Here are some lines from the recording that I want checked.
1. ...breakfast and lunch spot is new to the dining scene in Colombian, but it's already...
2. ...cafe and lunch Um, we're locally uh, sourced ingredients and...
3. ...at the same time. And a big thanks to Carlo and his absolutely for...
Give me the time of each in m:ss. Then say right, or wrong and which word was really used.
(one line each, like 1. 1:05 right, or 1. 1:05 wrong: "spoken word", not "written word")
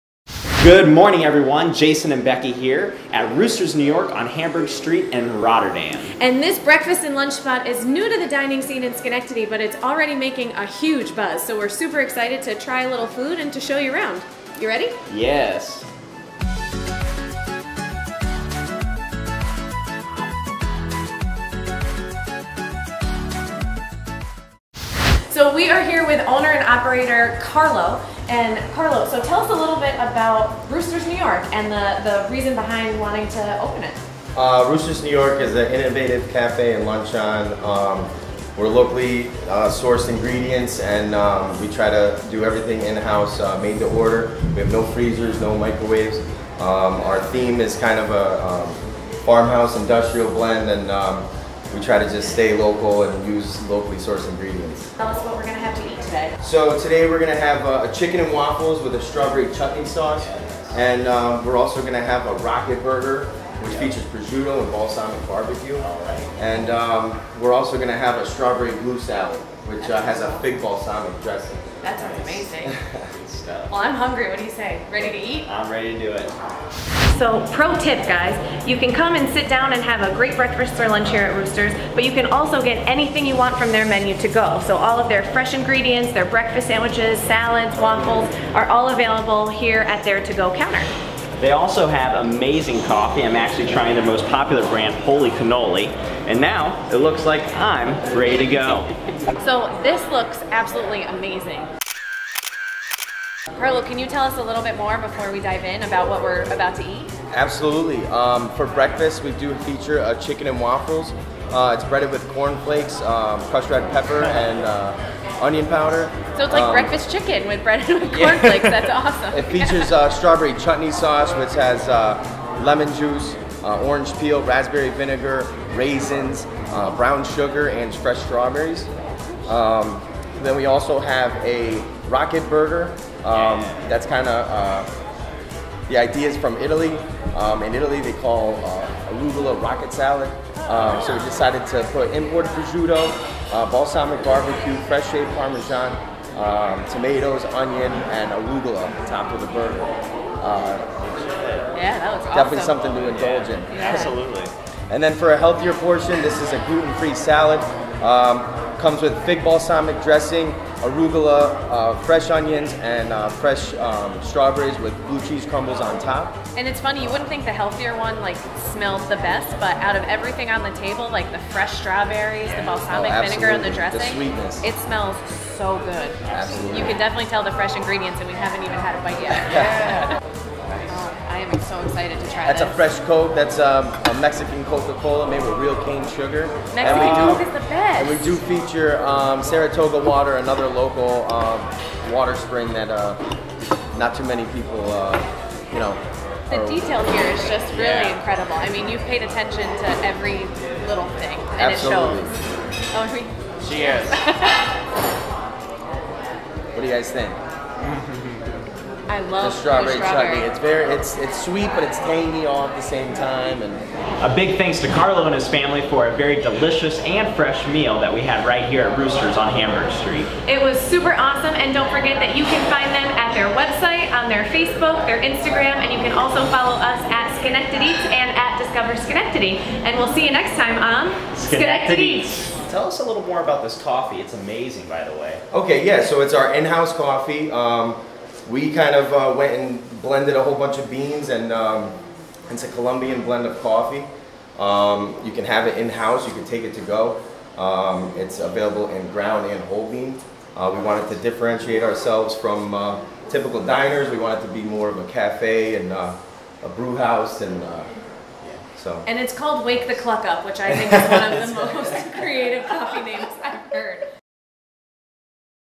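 1. 0:06 wrong: "Schenectady", not "Colombian"
2. 0:36 right
3. 3:32 wrong: "family", not "absolutely".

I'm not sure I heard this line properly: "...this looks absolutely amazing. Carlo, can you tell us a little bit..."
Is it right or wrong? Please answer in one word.
right.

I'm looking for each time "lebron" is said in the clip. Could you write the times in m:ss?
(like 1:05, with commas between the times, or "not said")
not said.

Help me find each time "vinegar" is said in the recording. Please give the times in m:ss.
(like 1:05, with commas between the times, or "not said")
2:04, 2:53.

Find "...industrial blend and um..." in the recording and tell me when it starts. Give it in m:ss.
0:49.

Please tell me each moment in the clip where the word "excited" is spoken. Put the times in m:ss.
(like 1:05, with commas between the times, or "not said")
0:12, 3:01.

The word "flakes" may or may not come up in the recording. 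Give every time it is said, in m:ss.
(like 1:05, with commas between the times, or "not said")
1:52, 1:58.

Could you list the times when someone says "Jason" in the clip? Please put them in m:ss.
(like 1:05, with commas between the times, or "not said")
0:01.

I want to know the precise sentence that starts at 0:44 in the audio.
We have no freezers, no microwaves.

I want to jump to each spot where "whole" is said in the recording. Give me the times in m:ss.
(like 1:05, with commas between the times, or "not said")
4:00, 4:09.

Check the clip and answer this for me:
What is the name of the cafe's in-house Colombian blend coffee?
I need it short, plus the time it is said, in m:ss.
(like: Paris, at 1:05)
Wake the Cluck Up, at 4:19.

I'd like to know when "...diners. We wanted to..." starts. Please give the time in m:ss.
4:13.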